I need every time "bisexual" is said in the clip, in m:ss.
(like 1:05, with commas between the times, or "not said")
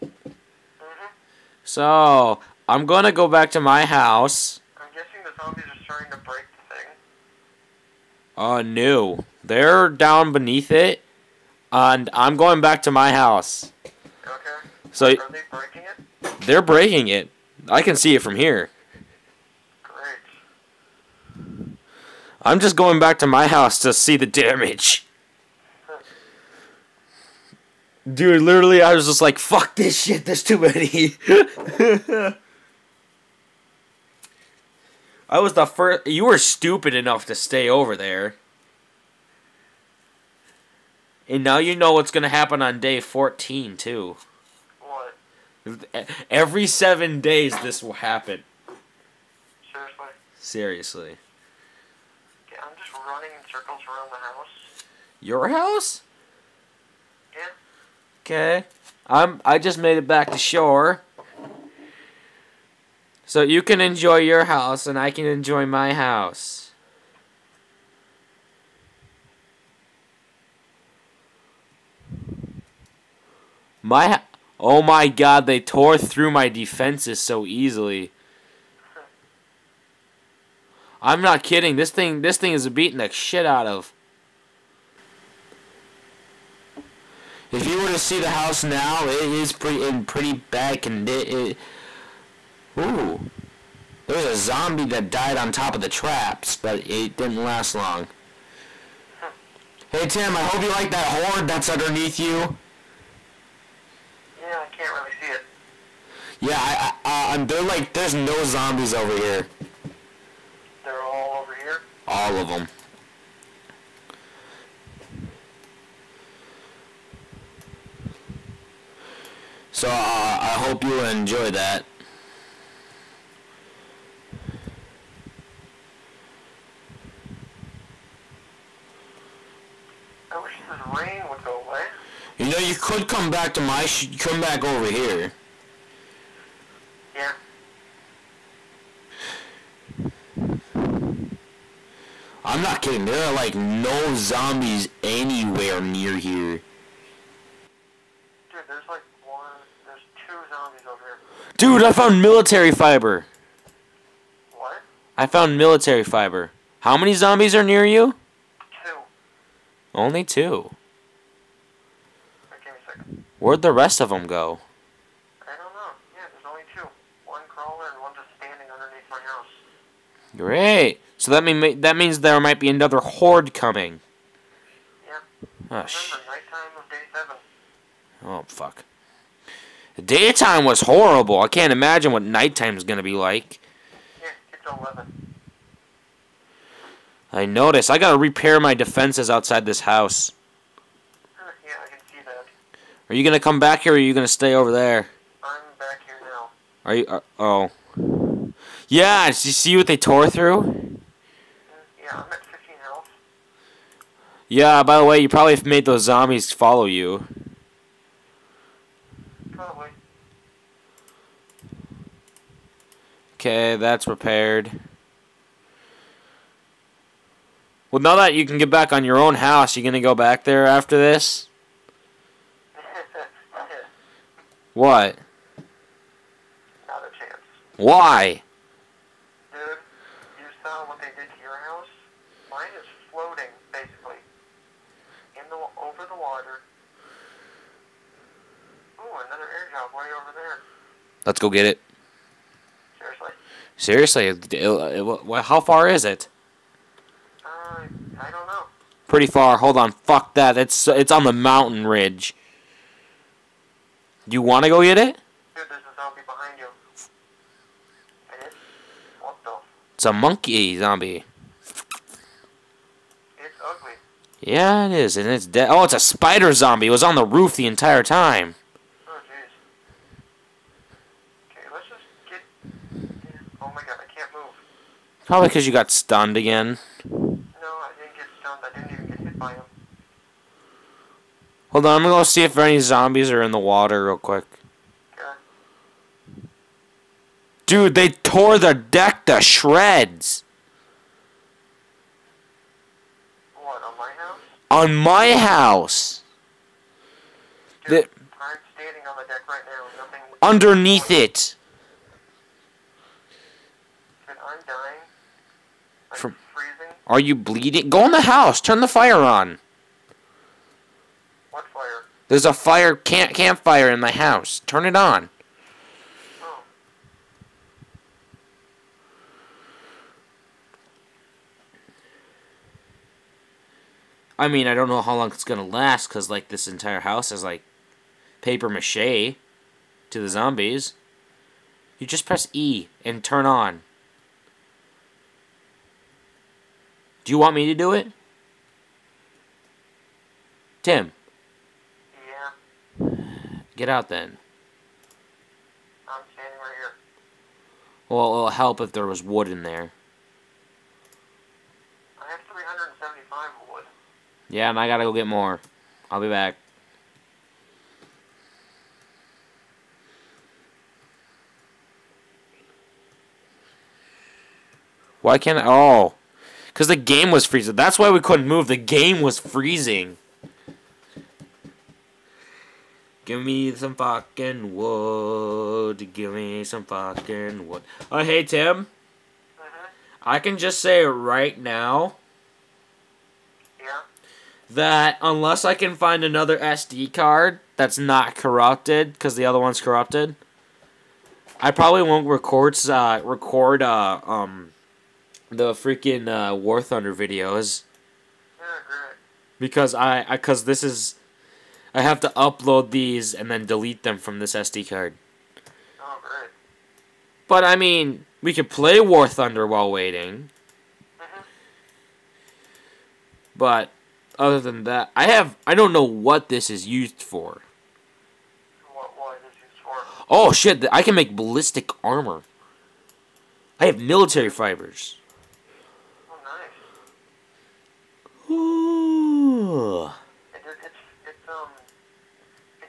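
not said.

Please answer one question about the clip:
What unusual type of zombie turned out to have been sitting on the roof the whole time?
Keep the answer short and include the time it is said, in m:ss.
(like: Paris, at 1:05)
Spider zombie, at 4:25.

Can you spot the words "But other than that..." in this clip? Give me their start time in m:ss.
6:53.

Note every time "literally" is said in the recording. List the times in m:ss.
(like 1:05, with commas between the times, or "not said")
0:28.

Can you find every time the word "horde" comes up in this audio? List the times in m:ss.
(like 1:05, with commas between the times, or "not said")
1:41, 2:52.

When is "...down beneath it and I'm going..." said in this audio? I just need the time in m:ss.
0:09.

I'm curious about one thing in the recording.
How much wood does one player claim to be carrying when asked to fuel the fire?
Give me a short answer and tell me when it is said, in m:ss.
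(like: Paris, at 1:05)
375, at 5:52.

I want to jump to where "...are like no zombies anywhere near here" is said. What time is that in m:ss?
2:23.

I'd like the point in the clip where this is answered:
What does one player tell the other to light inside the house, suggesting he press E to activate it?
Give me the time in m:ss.
5:13.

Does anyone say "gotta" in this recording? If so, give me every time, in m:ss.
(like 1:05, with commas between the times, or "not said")
3:07, 5:54.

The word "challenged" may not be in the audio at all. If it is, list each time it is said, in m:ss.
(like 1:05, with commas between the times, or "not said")
not said.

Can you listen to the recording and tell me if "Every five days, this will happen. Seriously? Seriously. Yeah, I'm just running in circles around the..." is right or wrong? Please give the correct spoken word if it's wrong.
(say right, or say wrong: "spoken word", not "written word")
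wrong: "seven", not "five".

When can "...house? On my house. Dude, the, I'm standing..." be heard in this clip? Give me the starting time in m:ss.
4:54.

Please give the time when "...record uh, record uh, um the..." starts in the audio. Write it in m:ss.
6:32.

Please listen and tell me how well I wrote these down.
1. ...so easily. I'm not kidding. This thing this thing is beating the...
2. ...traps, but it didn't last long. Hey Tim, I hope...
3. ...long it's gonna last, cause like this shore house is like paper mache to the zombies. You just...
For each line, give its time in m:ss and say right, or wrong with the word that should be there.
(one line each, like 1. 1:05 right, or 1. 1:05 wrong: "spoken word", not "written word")
1. 1:17 right
2. 1:35 right
3. 5:25 wrong: "entire", not "shore".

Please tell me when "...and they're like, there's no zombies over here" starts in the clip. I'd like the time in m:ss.
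1:47.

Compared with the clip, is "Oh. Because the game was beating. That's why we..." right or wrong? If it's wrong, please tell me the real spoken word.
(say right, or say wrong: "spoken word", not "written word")
wrong: "freezing", not "beating".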